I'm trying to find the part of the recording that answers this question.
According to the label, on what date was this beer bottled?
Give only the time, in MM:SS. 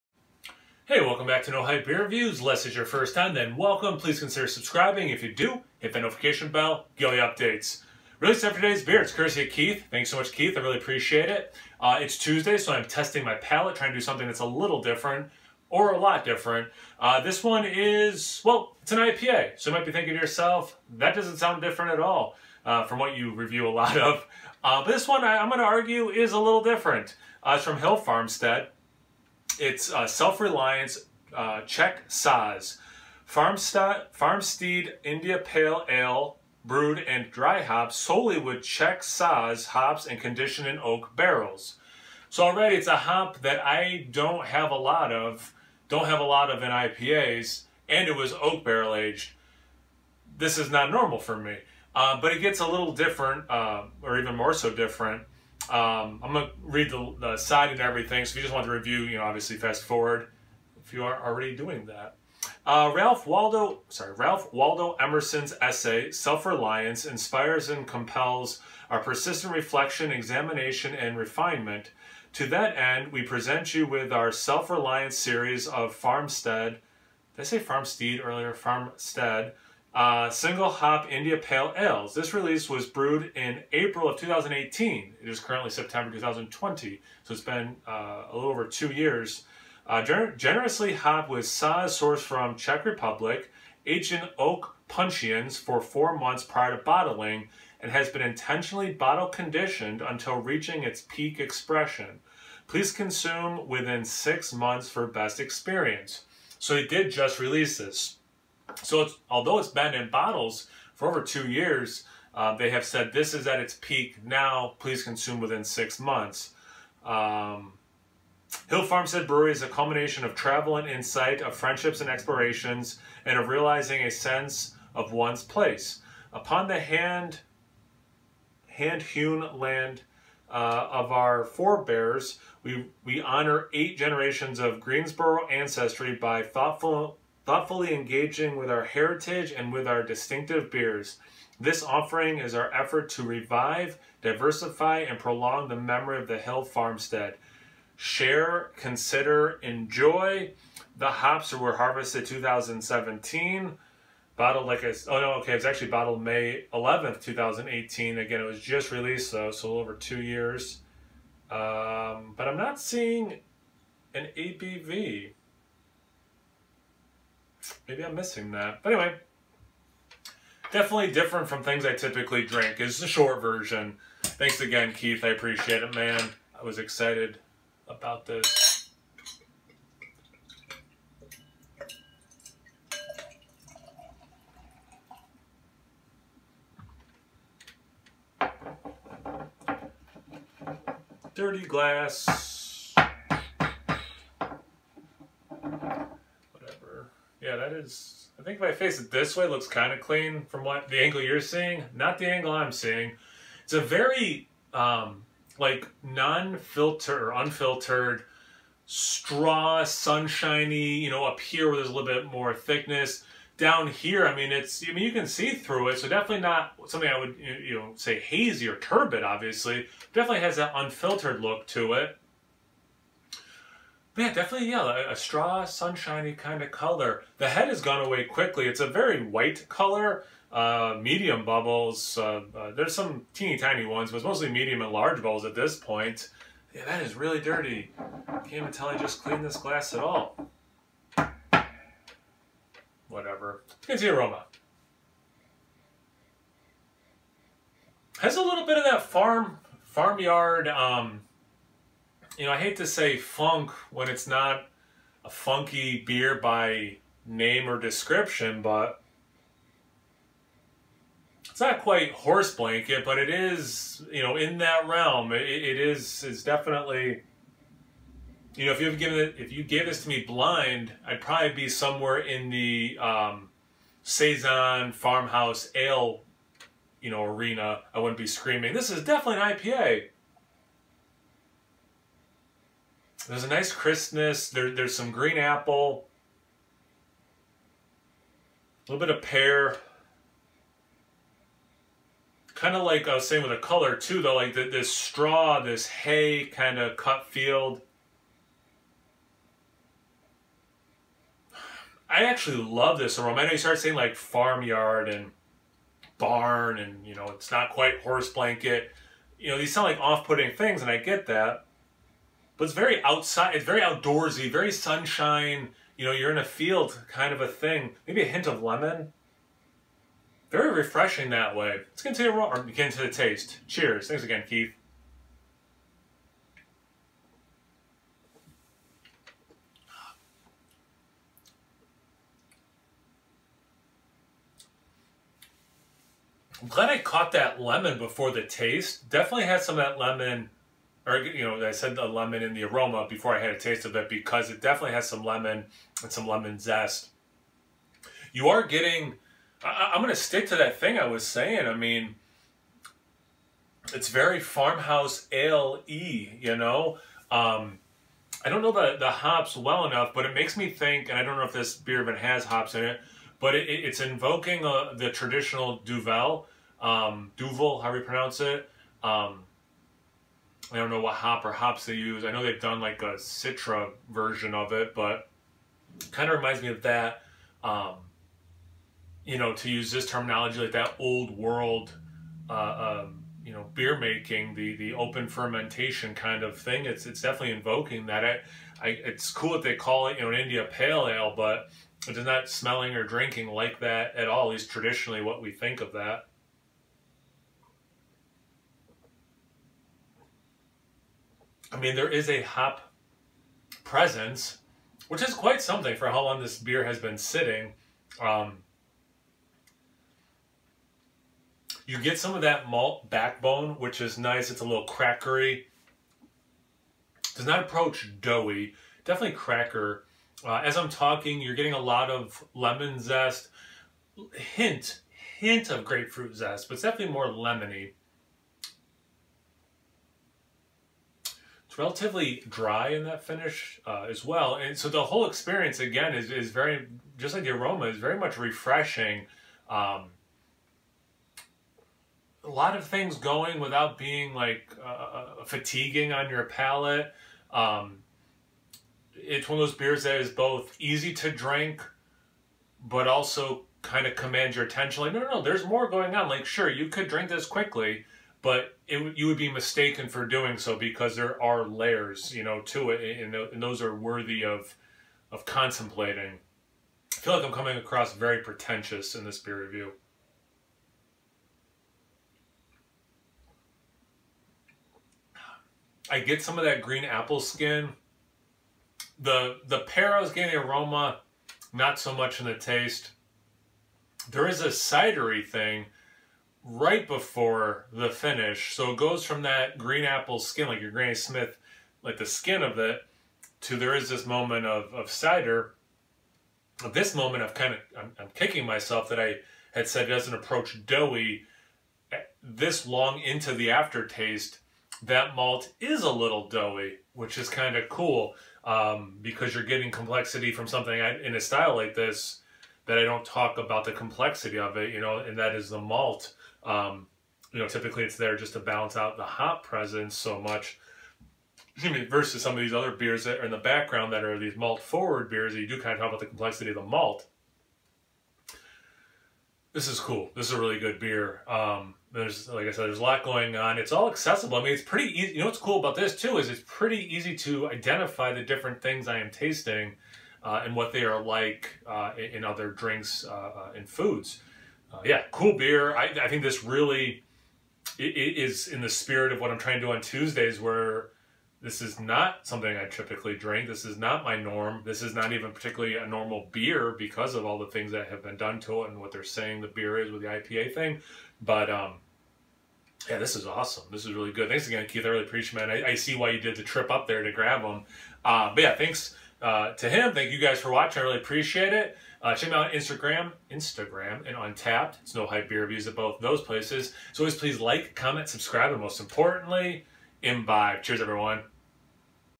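02:36.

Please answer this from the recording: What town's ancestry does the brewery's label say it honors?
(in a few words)
Greensboro.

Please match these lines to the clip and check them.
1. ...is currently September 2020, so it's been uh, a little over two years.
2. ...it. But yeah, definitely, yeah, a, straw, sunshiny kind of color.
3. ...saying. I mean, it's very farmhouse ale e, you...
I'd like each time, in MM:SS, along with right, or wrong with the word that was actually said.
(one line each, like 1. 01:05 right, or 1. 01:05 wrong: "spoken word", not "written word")
1. 01:25 right
2. 03:41 right
3. 05:51 right.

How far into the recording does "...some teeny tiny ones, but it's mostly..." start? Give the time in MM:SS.
03:52.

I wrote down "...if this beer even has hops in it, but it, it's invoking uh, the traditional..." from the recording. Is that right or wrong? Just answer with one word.
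right.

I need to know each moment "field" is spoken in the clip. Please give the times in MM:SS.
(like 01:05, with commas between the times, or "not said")
04:57, 05:16.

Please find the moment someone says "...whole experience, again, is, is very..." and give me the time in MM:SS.
07:15.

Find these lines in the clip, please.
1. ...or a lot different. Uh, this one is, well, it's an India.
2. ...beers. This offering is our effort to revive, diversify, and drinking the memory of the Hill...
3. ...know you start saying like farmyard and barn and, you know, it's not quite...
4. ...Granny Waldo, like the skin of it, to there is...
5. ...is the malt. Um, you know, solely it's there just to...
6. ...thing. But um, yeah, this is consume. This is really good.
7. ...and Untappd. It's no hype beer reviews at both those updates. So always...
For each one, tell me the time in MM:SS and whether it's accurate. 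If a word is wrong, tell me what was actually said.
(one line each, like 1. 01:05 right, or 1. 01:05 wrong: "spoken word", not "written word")
1. 00:15 wrong: "IPA", not "India"
2. 02:20 wrong: "prolong", not "drinking"
3. 05:03 right
4. 08:10 wrong: "Smith", not "Waldo"
5. 08:35 wrong: "typically", not "solely"
6. 09:20 wrong: "awesome", not "consume"
7. 09:34 wrong: "places", not "updates".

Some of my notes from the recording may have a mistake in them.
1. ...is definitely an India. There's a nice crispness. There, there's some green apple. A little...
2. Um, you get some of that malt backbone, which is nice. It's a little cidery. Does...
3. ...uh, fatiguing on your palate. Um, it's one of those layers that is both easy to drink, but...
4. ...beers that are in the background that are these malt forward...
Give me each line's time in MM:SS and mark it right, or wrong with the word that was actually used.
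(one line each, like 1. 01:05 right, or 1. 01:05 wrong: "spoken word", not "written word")
1. 04:38 wrong: "IPA", not "India"
2. 06:48 wrong: "crackery", not "cidery"
3. 07:24 wrong: "beers", not "layers"
4. 08:42 right.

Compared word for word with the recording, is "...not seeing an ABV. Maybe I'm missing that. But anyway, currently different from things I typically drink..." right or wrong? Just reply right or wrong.
wrong.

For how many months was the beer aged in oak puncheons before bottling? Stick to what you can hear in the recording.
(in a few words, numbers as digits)
4.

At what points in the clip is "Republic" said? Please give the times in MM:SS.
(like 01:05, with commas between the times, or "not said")
01:32.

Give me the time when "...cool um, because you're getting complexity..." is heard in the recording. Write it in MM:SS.
08:27.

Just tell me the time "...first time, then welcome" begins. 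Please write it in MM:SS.
00:02.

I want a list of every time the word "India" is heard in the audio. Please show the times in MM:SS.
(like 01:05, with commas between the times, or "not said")
00:35, 01:21, 06:30.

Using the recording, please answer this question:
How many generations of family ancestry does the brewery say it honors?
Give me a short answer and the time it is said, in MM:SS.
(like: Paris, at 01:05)
8, at 02:13.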